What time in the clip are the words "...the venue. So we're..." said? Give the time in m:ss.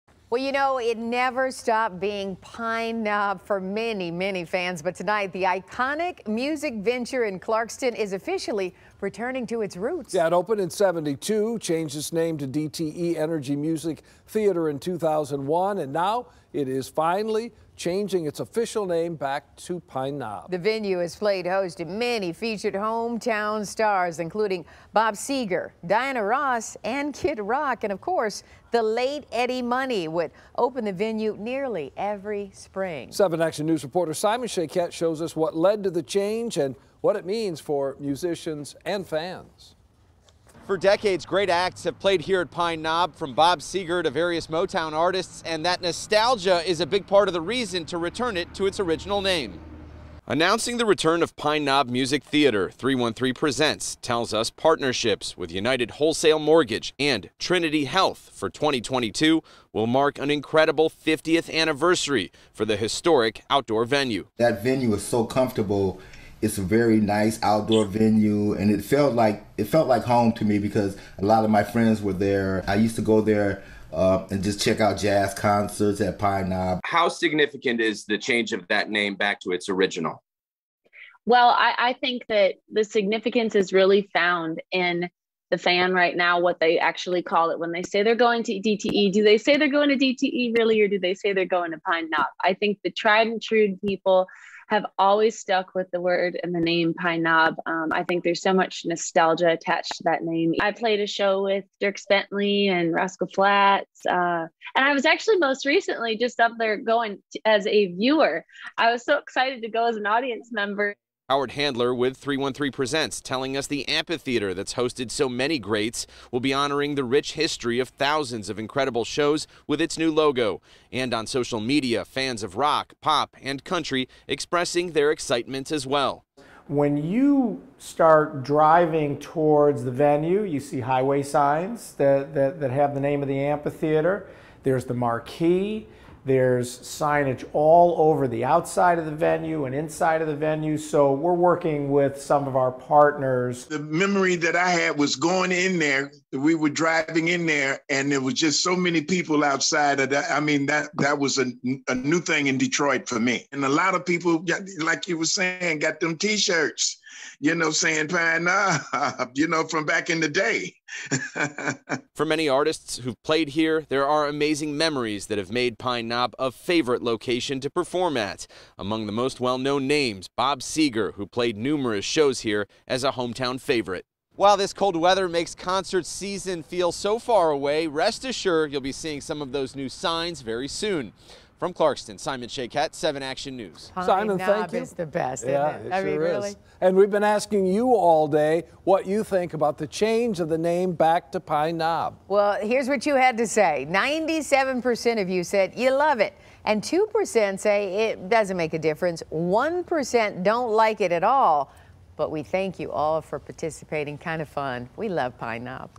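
2:20.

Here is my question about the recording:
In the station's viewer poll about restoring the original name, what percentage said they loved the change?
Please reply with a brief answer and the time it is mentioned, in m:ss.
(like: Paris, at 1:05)
97%, at 3:13.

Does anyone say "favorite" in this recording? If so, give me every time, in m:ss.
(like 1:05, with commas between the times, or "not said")
2:46, 2:53.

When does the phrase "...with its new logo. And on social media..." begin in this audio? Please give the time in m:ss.
1:59.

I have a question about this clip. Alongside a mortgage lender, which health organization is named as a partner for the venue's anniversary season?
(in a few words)
Trinity Health.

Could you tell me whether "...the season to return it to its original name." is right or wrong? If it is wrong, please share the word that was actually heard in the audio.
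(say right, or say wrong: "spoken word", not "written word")
wrong: "reason", not "season".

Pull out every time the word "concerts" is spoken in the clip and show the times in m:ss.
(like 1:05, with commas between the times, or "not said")
1:15, 2:55.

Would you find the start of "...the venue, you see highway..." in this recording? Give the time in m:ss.
2:09.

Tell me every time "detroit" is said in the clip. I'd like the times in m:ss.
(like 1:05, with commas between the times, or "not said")
2:32.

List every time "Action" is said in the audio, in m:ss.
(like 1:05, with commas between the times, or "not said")
0:33, 3:03.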